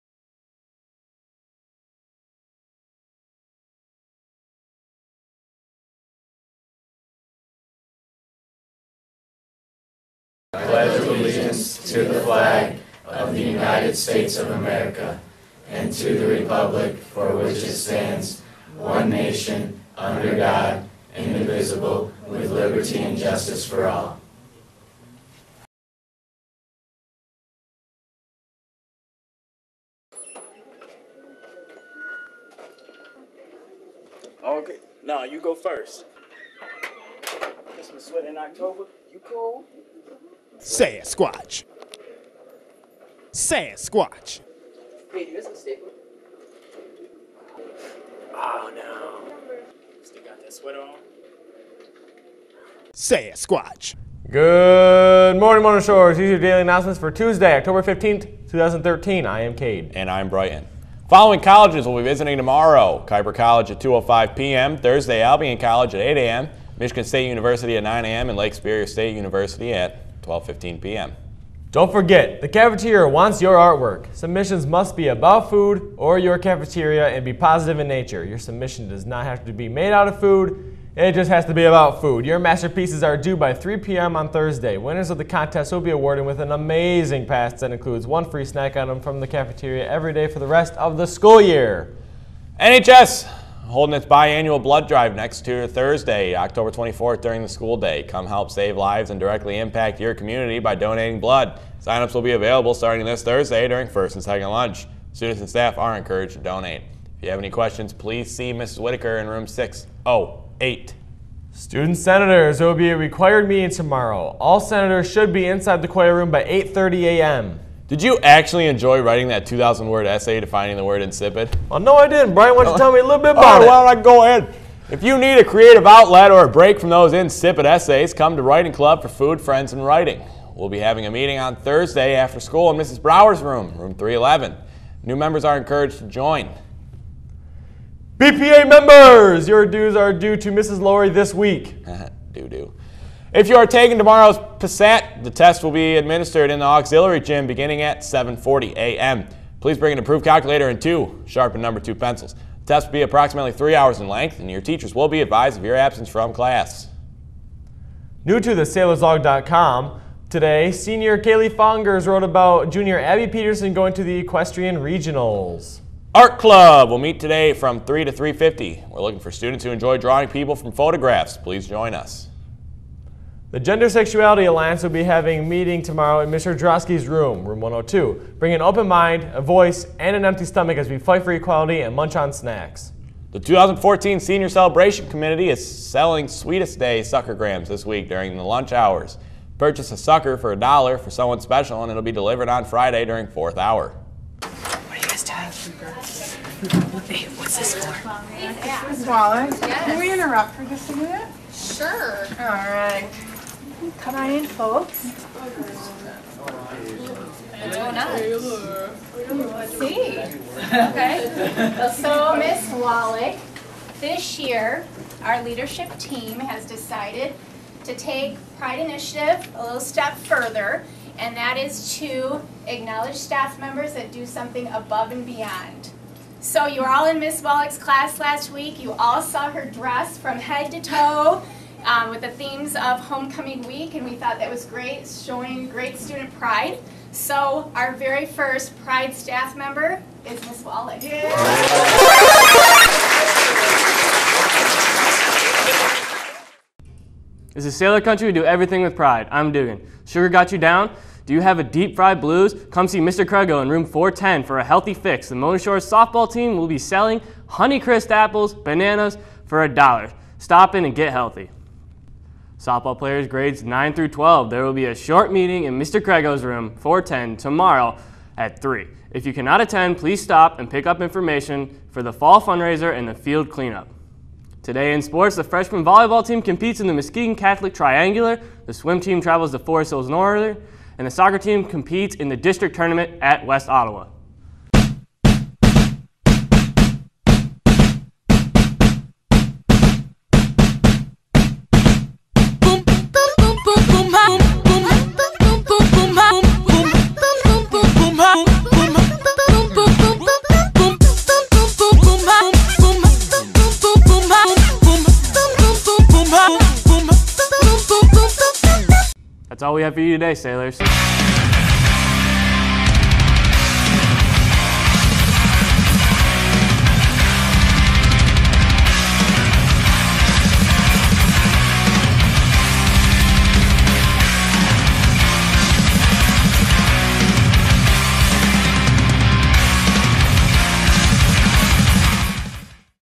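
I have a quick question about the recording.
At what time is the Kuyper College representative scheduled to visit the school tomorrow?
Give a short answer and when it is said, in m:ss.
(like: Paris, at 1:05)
2:05 p.m., at 1:03.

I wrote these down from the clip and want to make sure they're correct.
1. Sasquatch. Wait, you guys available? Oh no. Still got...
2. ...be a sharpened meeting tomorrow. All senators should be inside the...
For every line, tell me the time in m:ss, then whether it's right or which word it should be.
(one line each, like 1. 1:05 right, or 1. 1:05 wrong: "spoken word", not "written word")
1. 0:43 wrong: "staple", not "available"
2. 1:52 wrong: "required", not "sharpened".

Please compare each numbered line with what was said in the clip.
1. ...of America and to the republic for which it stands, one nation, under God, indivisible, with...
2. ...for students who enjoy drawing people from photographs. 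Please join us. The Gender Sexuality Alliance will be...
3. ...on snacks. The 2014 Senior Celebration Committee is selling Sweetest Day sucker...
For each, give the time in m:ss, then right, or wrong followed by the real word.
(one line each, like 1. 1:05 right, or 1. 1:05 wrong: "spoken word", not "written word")
1. 0:14 right
2. 2:49 right
3. 3:02 right.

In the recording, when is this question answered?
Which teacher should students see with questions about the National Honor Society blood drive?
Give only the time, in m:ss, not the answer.
1:48.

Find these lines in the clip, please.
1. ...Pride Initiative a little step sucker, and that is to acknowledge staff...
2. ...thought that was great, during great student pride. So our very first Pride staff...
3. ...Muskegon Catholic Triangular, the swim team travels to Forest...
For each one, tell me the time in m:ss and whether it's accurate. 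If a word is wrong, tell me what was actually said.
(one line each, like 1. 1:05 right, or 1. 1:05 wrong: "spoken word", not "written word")
1. 3:38 wrong: "further", not "sucker"
2. 3:54 wrong: "showing", not "during"
3. 4:36 right.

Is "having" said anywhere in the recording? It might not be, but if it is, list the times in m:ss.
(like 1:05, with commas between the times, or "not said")
2:10, 2:55.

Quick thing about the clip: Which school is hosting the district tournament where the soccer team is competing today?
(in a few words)
West Ottawa.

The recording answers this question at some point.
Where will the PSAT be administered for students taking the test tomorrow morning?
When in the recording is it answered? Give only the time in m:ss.
2:26.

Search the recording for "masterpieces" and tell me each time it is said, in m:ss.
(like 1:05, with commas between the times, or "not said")
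1:22.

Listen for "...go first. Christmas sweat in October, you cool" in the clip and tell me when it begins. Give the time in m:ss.
0:35.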